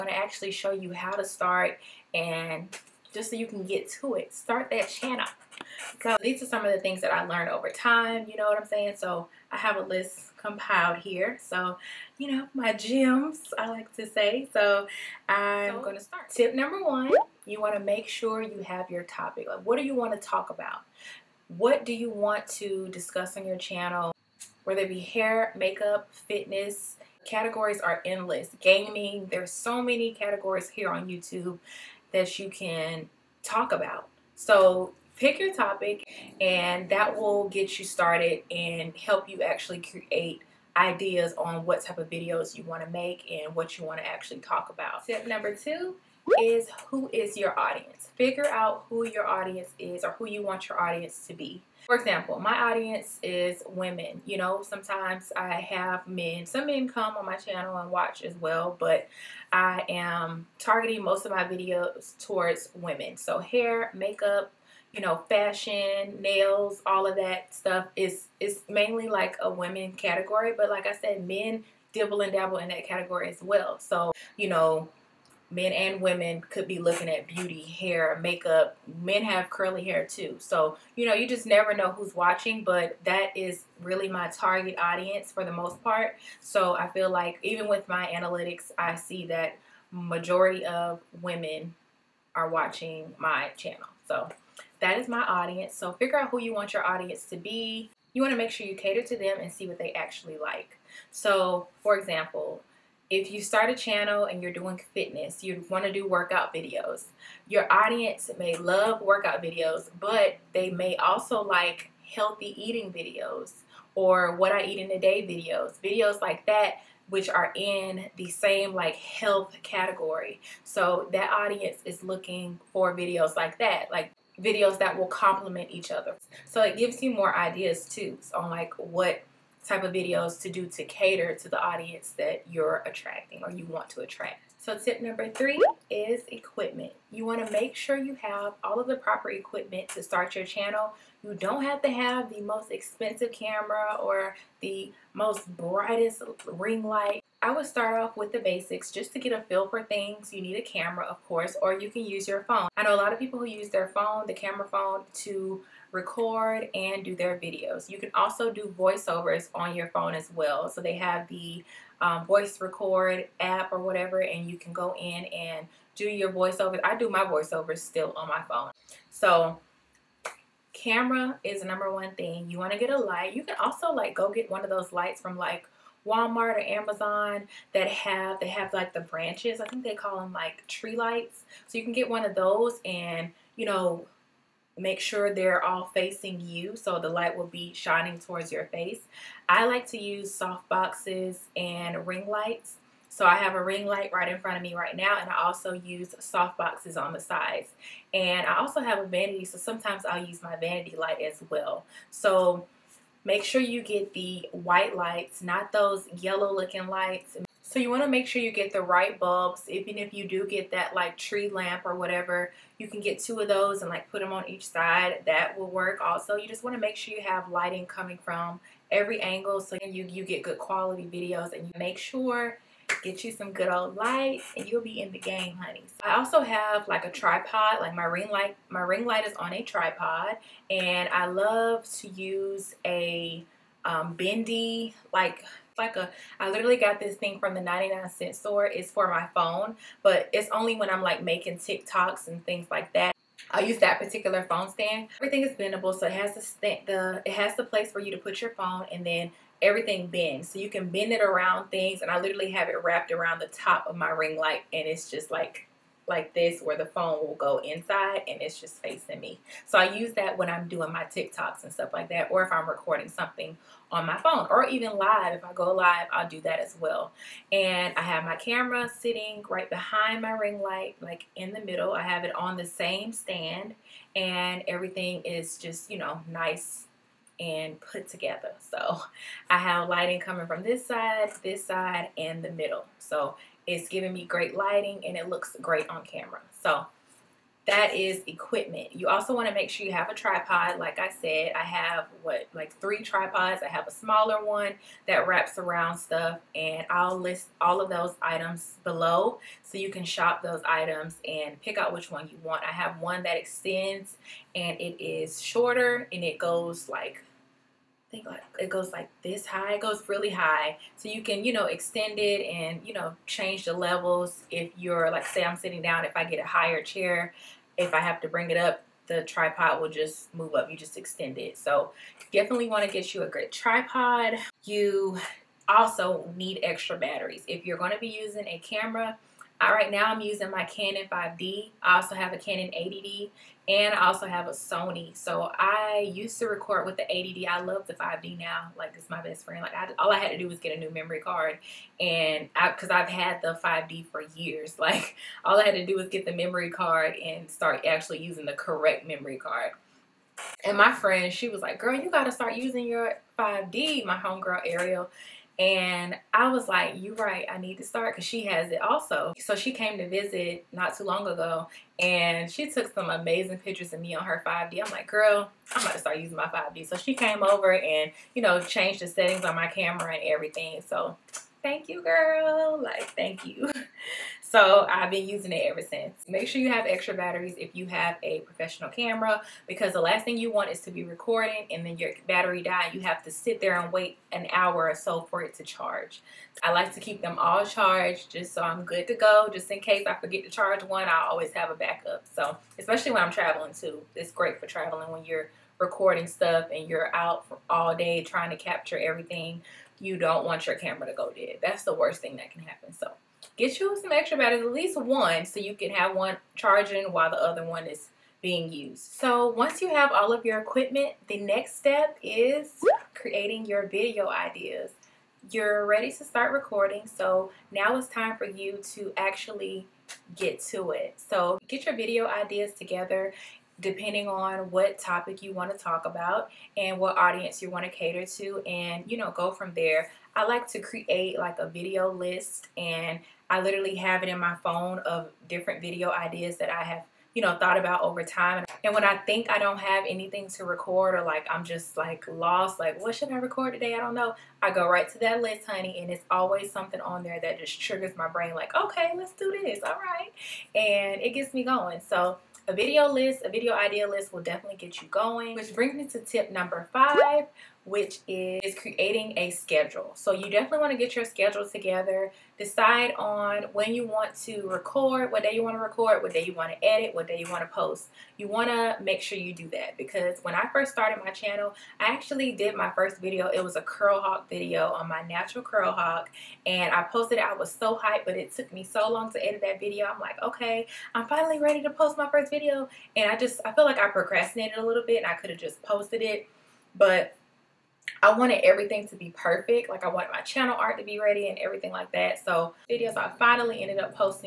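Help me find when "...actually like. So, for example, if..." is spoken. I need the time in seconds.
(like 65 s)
99 s.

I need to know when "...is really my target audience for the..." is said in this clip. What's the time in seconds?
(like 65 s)
83 s.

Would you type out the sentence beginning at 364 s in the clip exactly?
I'm like, girl, I'm about to start using my 5D.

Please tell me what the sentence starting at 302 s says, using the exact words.
I have one that extends and it is shorter and it goes like think it goes like this high.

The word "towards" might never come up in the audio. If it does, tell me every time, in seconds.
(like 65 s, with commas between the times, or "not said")
62 s, 188 s.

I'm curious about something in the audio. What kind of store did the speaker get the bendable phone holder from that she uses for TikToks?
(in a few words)
99 cent store.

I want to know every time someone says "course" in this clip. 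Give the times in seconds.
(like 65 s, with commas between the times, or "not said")
151 s.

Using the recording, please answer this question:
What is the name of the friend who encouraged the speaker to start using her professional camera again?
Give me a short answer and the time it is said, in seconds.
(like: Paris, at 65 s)
Ariel, at 354 s.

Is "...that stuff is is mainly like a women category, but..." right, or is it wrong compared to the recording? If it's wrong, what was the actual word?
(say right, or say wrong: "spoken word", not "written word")
right.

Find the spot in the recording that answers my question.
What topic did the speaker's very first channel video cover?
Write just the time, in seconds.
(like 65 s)
475 s.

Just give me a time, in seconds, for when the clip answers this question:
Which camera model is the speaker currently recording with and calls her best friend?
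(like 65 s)
330 s.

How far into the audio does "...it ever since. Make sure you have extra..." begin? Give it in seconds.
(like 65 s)
375 s.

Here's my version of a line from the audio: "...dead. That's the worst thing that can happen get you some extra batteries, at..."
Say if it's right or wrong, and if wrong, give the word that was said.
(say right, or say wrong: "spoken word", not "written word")
right.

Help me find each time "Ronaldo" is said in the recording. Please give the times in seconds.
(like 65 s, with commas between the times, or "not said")
not said.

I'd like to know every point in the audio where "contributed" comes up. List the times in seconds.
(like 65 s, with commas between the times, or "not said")
not said.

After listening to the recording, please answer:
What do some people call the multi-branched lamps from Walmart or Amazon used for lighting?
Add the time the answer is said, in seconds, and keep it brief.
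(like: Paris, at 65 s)
Tree lights, at 180 s.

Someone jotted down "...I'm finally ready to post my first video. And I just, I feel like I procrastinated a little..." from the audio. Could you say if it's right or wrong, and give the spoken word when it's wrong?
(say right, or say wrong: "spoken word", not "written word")
right.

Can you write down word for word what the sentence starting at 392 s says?
So especially when I'm traveling too.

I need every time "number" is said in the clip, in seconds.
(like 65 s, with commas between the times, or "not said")
16 s, 45 s, 135 s, 171 s, 456 s.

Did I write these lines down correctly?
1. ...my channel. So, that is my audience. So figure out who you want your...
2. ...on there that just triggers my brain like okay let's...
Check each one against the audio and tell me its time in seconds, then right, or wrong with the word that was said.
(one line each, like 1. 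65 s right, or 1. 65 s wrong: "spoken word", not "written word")
1. 93 s right
2. 446 s right.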